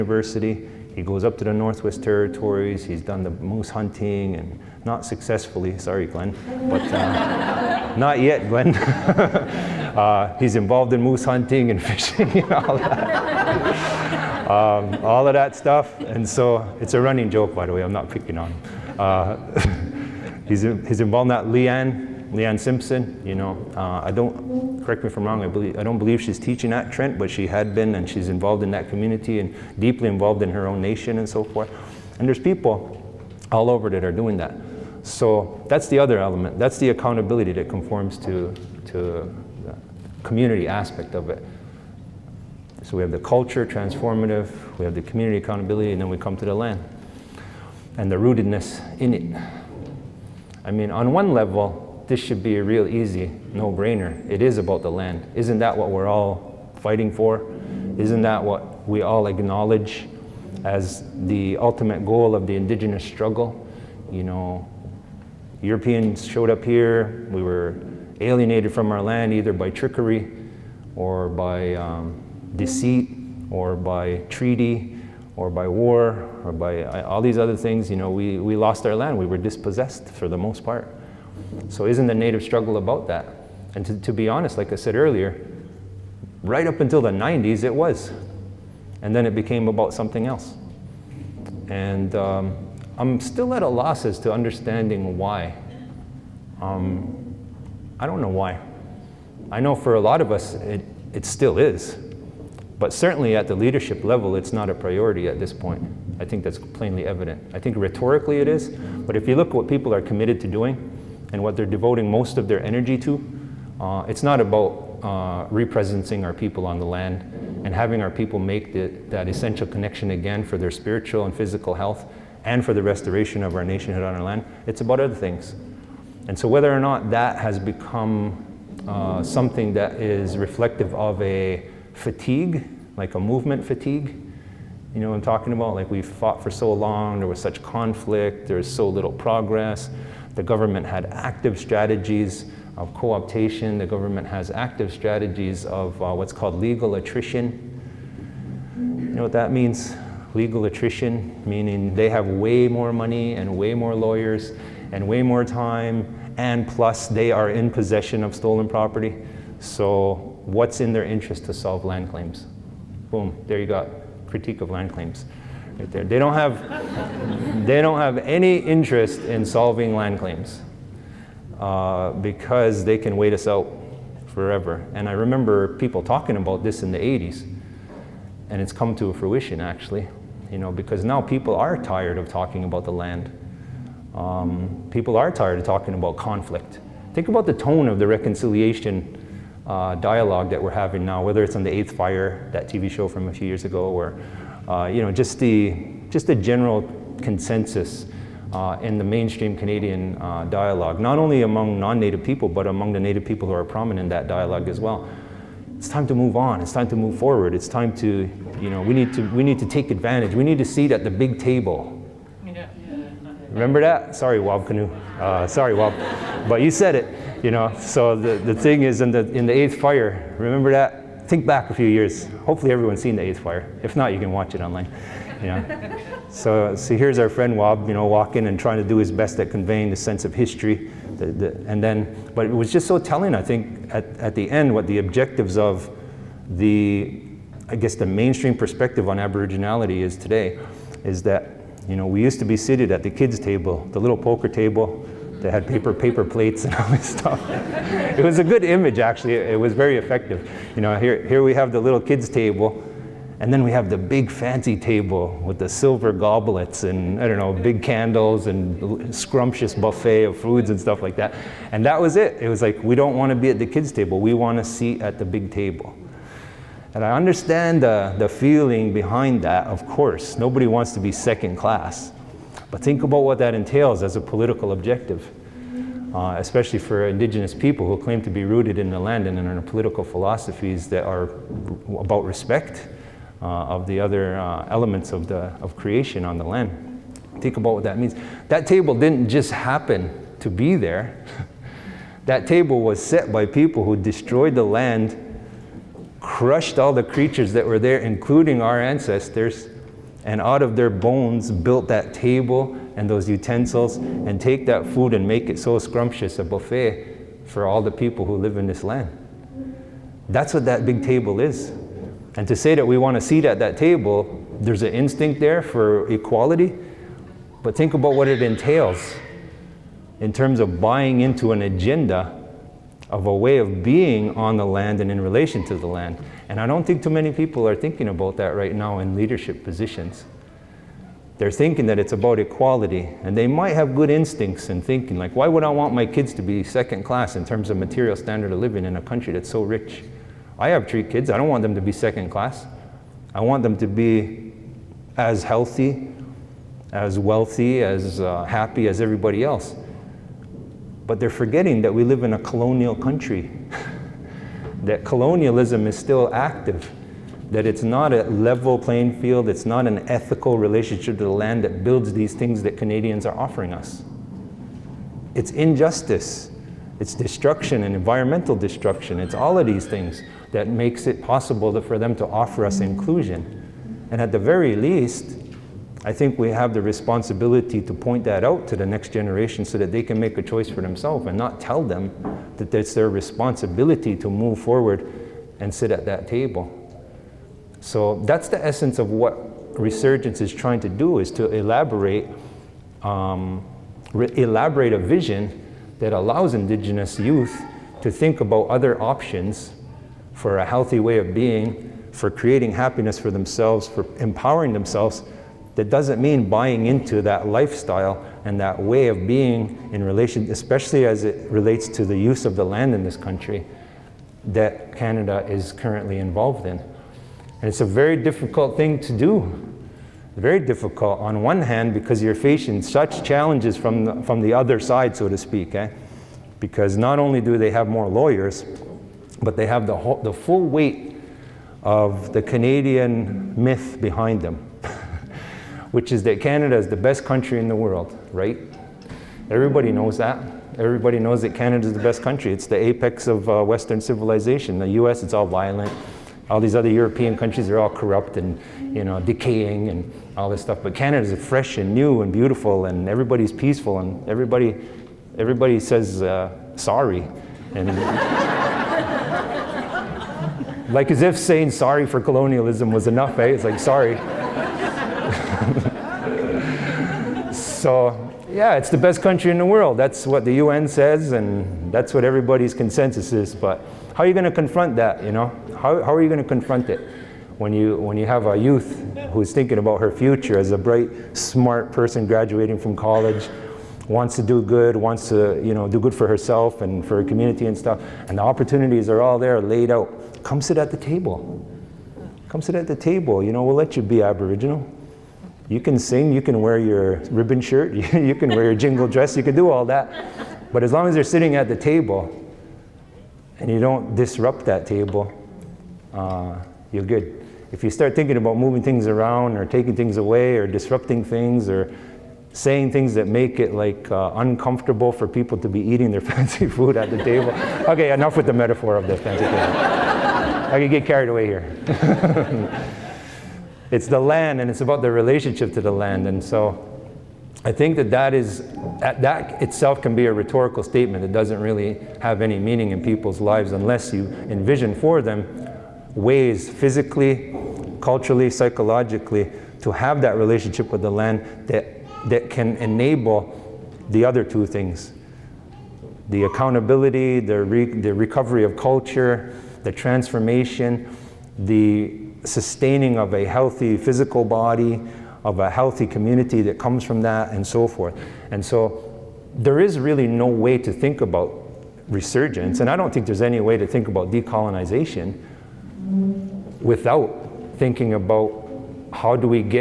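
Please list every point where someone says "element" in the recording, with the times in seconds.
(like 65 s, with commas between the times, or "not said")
36 s, 284 s.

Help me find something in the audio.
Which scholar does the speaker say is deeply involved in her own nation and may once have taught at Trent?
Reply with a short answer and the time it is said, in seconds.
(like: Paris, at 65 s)
Leanne Simpson, at 22 s.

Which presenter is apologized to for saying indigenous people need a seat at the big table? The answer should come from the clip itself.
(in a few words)
Wab Kinew.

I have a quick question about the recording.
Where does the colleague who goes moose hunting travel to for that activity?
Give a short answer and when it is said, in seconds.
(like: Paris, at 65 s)
Northwest Territories, at 1 s.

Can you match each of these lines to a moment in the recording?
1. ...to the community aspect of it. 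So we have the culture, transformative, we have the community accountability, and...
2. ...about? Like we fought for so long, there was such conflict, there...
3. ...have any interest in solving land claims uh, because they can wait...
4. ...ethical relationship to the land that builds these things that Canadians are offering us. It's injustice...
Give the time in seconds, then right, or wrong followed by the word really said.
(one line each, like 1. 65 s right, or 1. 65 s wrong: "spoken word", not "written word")
1. 38 s right
2. 135 s right
3. 168 s right
4. 360 s right.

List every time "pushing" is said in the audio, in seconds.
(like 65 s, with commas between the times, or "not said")
not said.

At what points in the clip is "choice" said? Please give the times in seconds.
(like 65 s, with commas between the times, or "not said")
380 s.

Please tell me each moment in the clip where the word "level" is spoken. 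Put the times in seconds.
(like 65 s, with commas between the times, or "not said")
51 s, 104 s, 358 s.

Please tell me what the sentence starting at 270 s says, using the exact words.
Nobody wants to be second class.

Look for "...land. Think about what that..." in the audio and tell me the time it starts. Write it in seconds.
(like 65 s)
286 s.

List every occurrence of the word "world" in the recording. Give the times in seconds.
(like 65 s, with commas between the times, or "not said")
437 s, 469 s.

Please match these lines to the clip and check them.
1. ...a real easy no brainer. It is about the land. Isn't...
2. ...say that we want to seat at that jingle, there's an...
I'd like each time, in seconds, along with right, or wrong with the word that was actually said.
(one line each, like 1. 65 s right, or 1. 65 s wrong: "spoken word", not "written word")
1. 52 s right
2. 312 s wrong: "table", not "jingle".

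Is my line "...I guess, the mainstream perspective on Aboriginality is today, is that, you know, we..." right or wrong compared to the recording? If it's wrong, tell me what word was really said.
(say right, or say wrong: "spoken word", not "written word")
right.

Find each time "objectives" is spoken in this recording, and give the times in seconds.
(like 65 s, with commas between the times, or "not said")
234 s, 274 s.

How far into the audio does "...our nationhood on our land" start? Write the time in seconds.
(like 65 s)
123 s.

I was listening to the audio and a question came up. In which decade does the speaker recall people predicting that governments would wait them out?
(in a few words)
the 80s.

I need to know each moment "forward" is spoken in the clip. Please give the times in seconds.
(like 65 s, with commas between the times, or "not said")
207 s, 384 s.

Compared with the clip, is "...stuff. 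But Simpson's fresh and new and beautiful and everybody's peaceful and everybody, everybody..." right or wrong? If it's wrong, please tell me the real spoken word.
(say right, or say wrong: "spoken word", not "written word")
wrong: "Canada", not "Simpson".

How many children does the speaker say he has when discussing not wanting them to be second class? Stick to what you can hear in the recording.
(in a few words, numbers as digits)
3.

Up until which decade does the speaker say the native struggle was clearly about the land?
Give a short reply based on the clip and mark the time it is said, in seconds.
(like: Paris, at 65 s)
the 90s, at 87 s.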